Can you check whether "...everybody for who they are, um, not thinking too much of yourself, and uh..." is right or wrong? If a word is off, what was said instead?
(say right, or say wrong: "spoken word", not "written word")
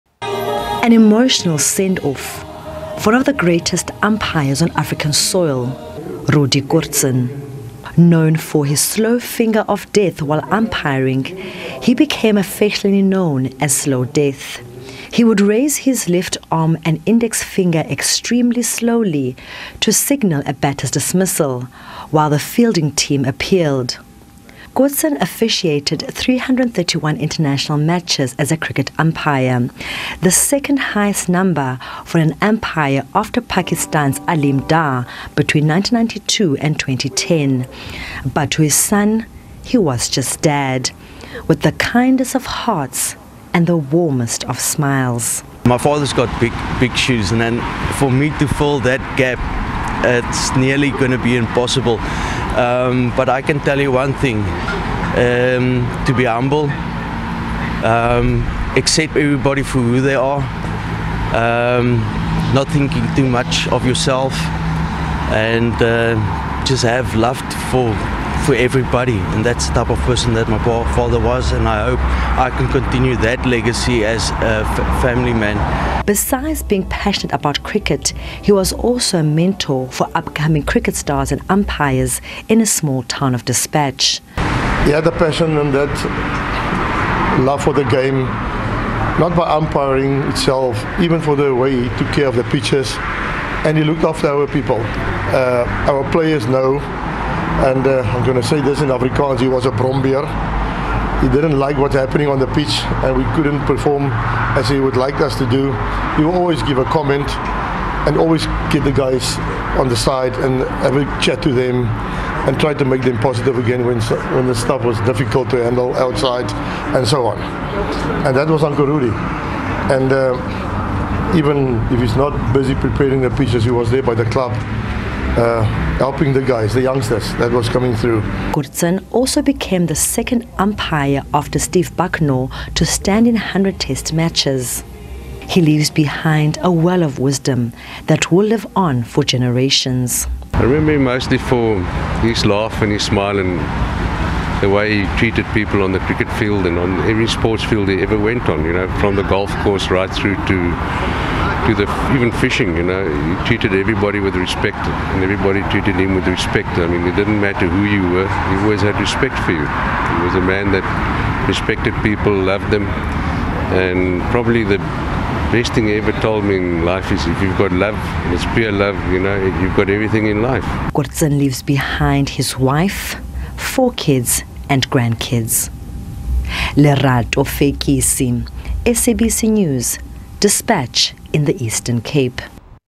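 right.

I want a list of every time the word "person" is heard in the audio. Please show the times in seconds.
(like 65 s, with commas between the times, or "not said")
69 s.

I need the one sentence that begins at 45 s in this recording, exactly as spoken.
My father's got big, big shoes, and then for me to fill that gap, it's nearly going to be impossible.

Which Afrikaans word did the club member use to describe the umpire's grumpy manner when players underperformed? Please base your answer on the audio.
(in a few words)
brombeer.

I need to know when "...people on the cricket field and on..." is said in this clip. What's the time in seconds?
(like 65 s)
145 s.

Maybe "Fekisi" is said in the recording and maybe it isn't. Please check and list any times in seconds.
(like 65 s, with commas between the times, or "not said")
177 s.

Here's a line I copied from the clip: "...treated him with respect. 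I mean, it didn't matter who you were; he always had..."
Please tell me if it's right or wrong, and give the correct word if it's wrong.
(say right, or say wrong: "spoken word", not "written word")
right.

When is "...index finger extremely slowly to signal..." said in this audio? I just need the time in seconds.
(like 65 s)
17 s.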